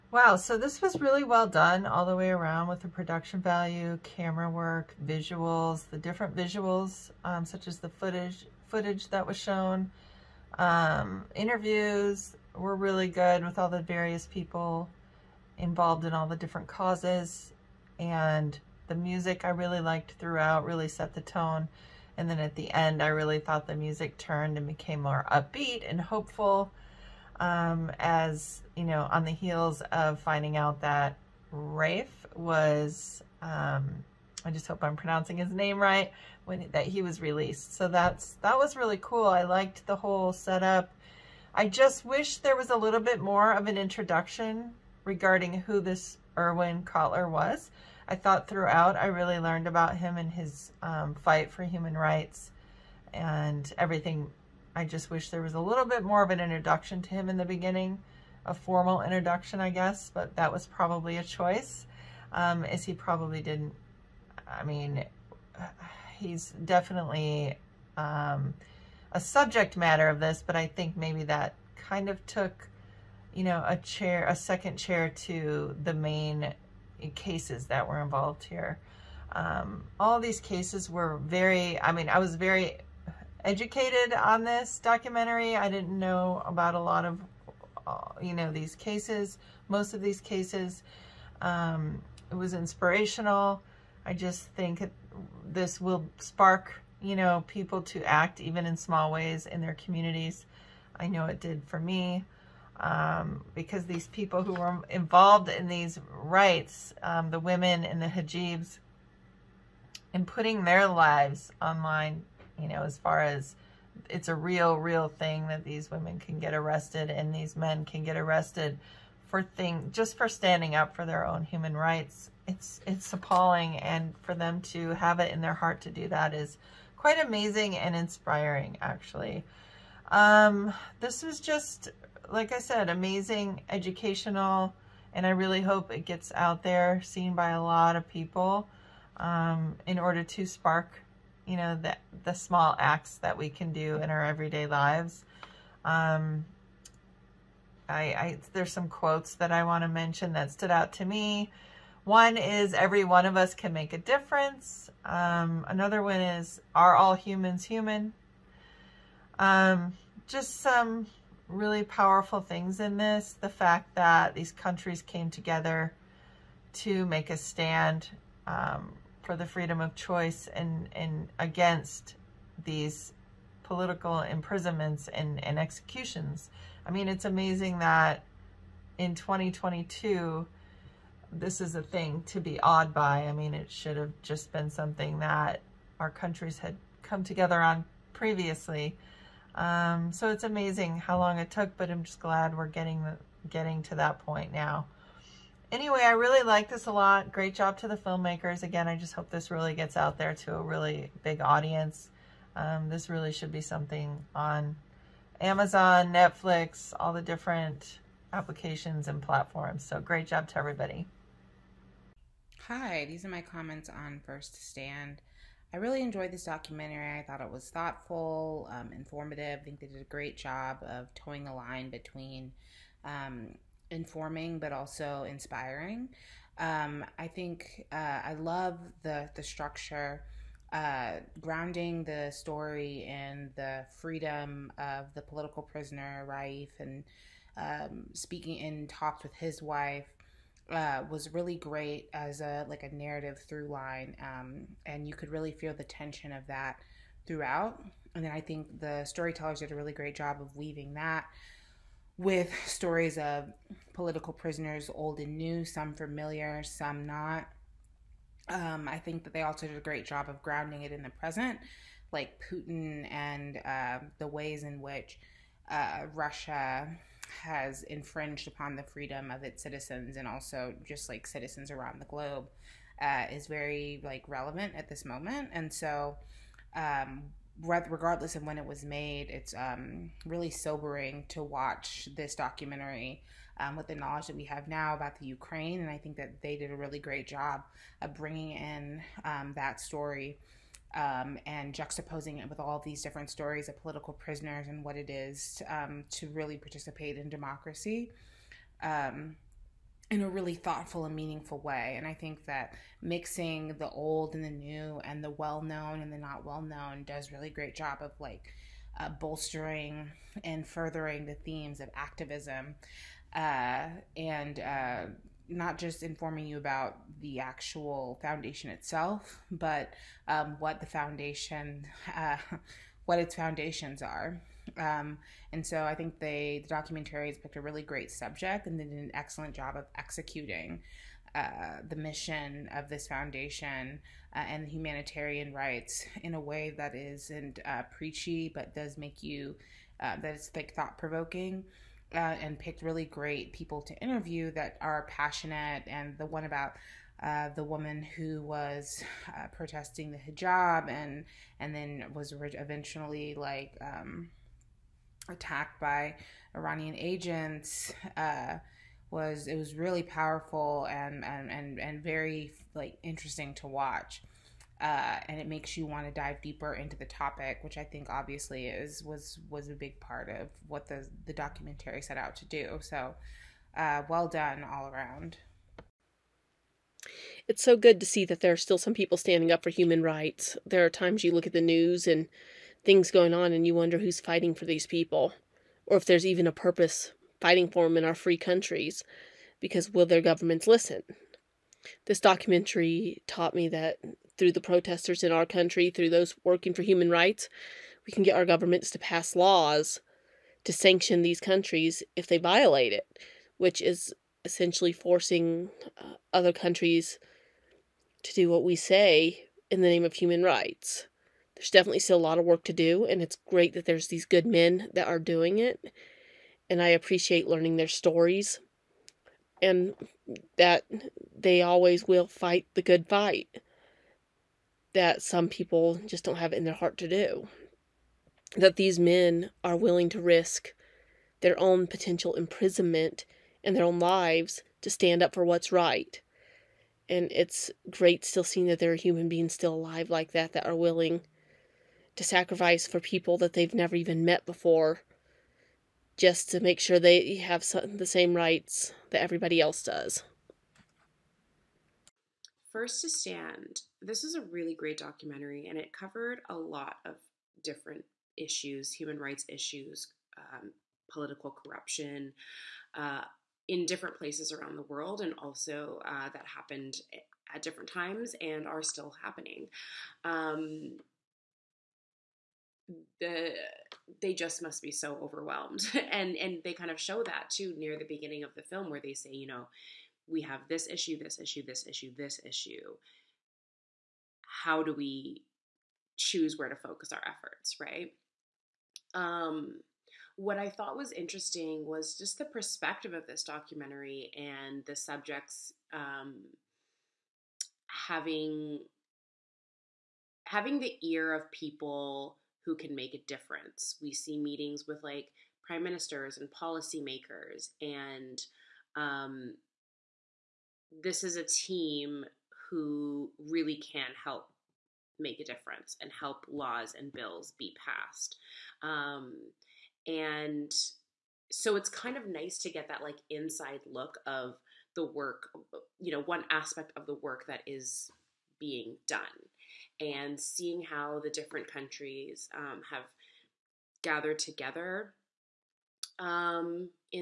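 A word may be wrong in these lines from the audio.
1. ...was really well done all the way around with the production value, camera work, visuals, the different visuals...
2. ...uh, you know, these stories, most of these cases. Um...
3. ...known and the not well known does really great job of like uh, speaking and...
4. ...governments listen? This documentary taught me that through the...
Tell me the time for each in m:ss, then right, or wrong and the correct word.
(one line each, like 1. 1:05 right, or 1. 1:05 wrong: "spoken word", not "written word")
1. 0:00 right
2. 1:27 wrong: "cases", not "stories"
3. 5:05 wrong: "bolstering", not "speaking"
4. 6:30 right.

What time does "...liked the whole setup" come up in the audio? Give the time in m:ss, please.
0:39.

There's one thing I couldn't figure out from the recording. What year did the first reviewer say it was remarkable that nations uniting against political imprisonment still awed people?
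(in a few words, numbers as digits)
2022.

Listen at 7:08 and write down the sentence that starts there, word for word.
That these men are willing to risk their own potential imprisonment and their own lives to stand up for what's right.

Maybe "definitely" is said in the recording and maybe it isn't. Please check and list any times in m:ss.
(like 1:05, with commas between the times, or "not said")
1:06, 6:51.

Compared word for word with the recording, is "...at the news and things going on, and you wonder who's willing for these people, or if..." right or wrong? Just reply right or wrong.
wrong.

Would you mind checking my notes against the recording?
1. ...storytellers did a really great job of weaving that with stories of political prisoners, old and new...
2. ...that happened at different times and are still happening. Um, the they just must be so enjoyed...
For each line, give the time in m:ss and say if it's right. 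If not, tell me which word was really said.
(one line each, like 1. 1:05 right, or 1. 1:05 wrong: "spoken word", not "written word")
1. 4:09 right
2. 7:46 wrong: "overwhelmed", not "enjoyed".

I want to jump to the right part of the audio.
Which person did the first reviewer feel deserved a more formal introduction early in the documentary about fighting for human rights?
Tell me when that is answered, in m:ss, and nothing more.
0:46.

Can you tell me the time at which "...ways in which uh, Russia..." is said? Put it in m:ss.
4:24.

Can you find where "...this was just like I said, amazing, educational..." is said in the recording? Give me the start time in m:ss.
2:10.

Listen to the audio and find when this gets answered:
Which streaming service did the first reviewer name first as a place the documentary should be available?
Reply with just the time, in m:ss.
3:25.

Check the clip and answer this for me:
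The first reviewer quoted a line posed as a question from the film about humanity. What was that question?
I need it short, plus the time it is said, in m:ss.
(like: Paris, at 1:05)
Are all humans human?, at 2:36.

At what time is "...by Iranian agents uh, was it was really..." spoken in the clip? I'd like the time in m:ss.
5:55.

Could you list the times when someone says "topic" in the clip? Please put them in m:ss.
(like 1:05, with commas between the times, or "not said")
6:07.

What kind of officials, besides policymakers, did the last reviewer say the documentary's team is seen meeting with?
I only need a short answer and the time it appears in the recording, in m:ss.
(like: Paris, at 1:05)
prime ministers, at 8:25.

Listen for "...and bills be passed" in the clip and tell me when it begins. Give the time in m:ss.
8:36.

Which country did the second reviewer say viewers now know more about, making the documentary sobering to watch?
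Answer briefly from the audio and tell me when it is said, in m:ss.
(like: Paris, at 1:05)
Ukraine, at 4:45.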